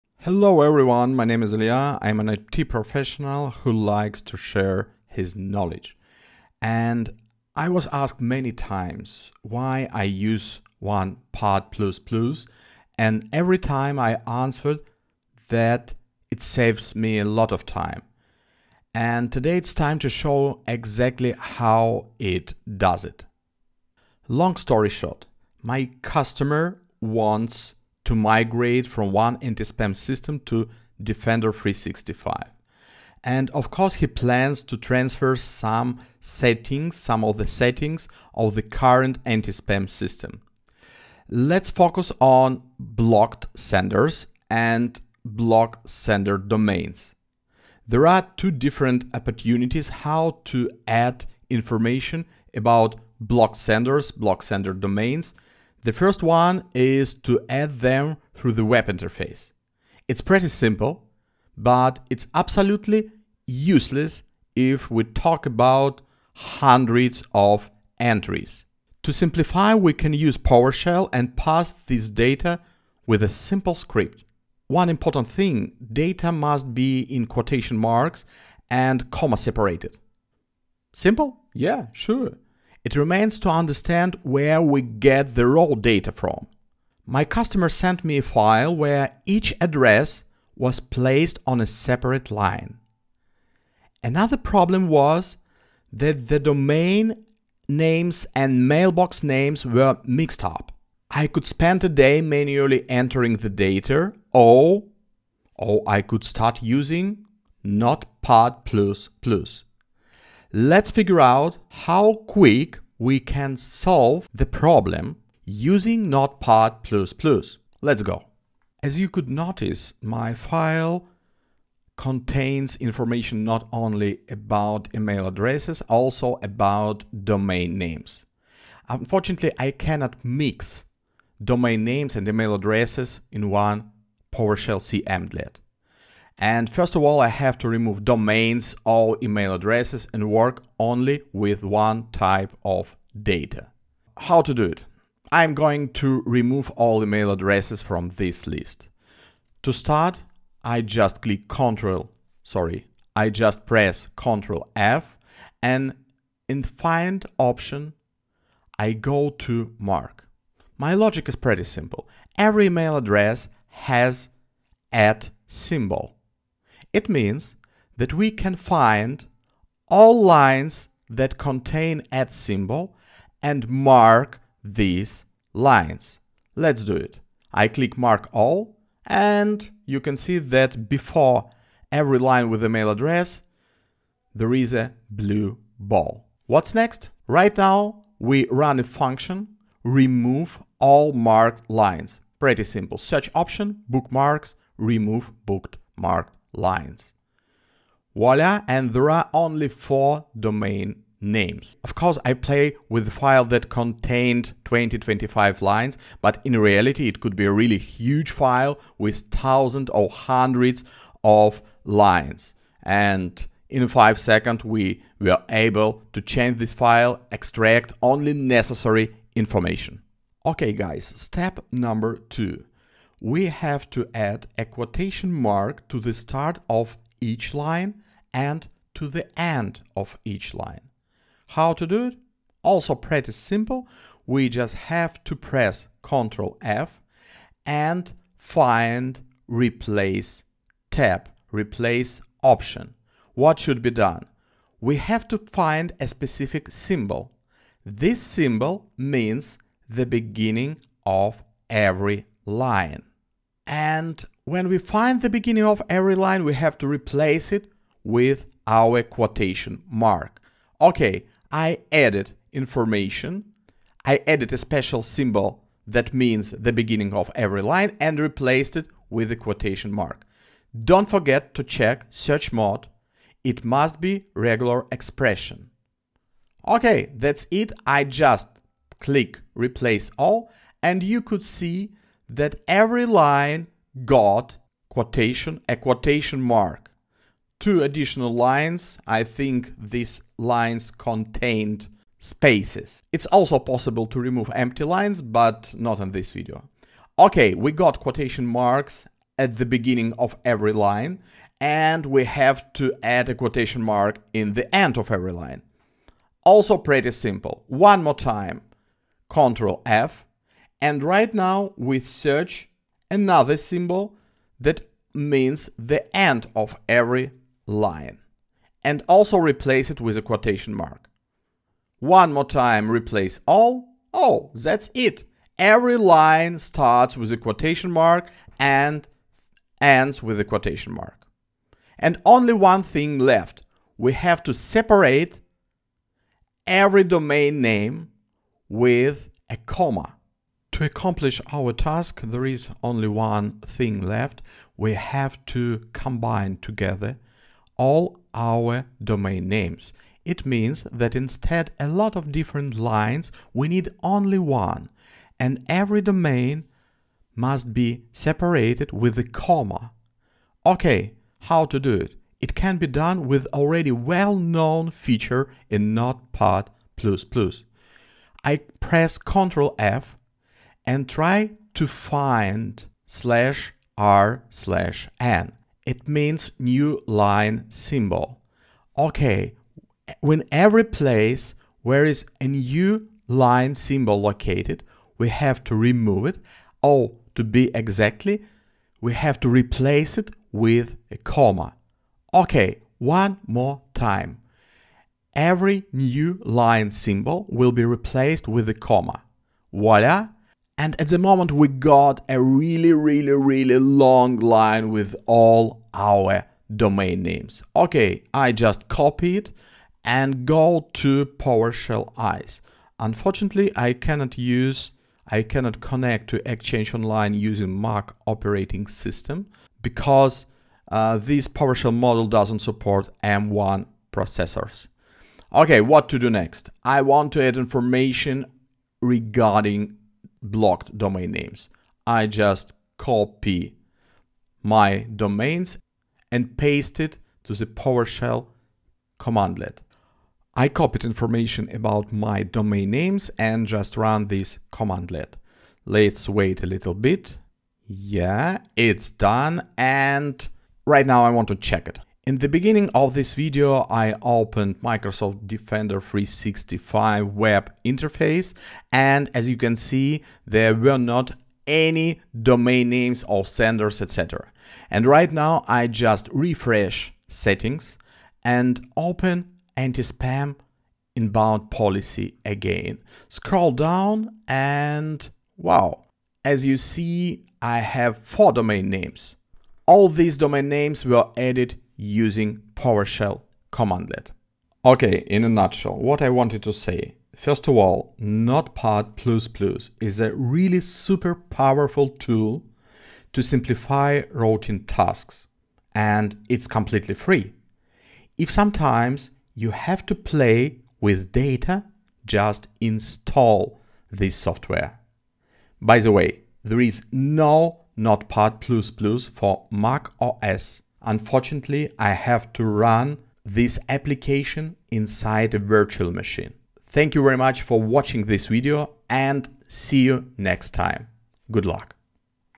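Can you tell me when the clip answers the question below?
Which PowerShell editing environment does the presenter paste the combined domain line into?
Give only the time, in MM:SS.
06:51.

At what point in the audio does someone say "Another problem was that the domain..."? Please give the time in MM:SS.
01:34.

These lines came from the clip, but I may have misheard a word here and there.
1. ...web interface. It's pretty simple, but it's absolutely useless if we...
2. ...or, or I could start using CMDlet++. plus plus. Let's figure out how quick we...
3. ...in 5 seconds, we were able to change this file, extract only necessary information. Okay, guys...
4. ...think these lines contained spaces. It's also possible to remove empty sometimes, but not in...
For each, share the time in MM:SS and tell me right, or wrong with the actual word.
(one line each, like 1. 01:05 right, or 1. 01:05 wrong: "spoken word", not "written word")
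1. 00:58 right
2. 01:44 wrong: "Notepad", not "CMDlet"
3. 03:33 right
4. 04:49 wrong: "lines", not "sometimes".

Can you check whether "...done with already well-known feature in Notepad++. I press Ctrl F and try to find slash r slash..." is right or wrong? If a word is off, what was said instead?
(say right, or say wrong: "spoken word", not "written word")
right.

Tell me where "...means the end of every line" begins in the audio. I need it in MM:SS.
05:15.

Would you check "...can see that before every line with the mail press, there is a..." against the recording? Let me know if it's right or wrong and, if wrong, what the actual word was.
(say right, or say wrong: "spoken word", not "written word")
wrong: "address", not "press".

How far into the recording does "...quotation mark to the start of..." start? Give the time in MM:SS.
03:44.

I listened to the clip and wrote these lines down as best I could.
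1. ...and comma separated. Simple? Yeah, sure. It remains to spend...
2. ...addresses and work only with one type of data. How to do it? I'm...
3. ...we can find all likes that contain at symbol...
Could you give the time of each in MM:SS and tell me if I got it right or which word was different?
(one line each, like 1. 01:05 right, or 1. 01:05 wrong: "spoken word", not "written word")
1. 01:18 wrong: "understand", not "spend"
2. 02:19 right
3. 02:48 wrong: "lines", not "likes".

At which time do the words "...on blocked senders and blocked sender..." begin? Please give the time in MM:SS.
00:42.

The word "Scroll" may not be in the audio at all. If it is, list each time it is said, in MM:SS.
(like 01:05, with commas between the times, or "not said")
07:53.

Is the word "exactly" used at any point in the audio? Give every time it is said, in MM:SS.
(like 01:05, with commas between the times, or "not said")
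00:20, 06:27.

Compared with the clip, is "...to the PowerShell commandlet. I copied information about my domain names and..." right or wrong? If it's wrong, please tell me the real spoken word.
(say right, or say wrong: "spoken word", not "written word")
right.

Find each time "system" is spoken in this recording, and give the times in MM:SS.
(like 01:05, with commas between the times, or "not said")
00:29, 00:39, 06:58.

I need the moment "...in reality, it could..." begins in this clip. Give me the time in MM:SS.
03:26.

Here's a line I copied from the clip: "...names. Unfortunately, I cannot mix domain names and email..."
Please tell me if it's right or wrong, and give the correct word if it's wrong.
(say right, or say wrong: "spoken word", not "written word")
right.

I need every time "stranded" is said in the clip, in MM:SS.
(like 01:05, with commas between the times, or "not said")
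not said.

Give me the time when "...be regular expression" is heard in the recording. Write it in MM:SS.
04:34.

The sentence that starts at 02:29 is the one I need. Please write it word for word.
To start, I just click Ctrl, sorry, I just press Ctrl F and in find option, I go to mark.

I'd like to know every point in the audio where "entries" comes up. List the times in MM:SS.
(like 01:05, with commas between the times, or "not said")
01:07.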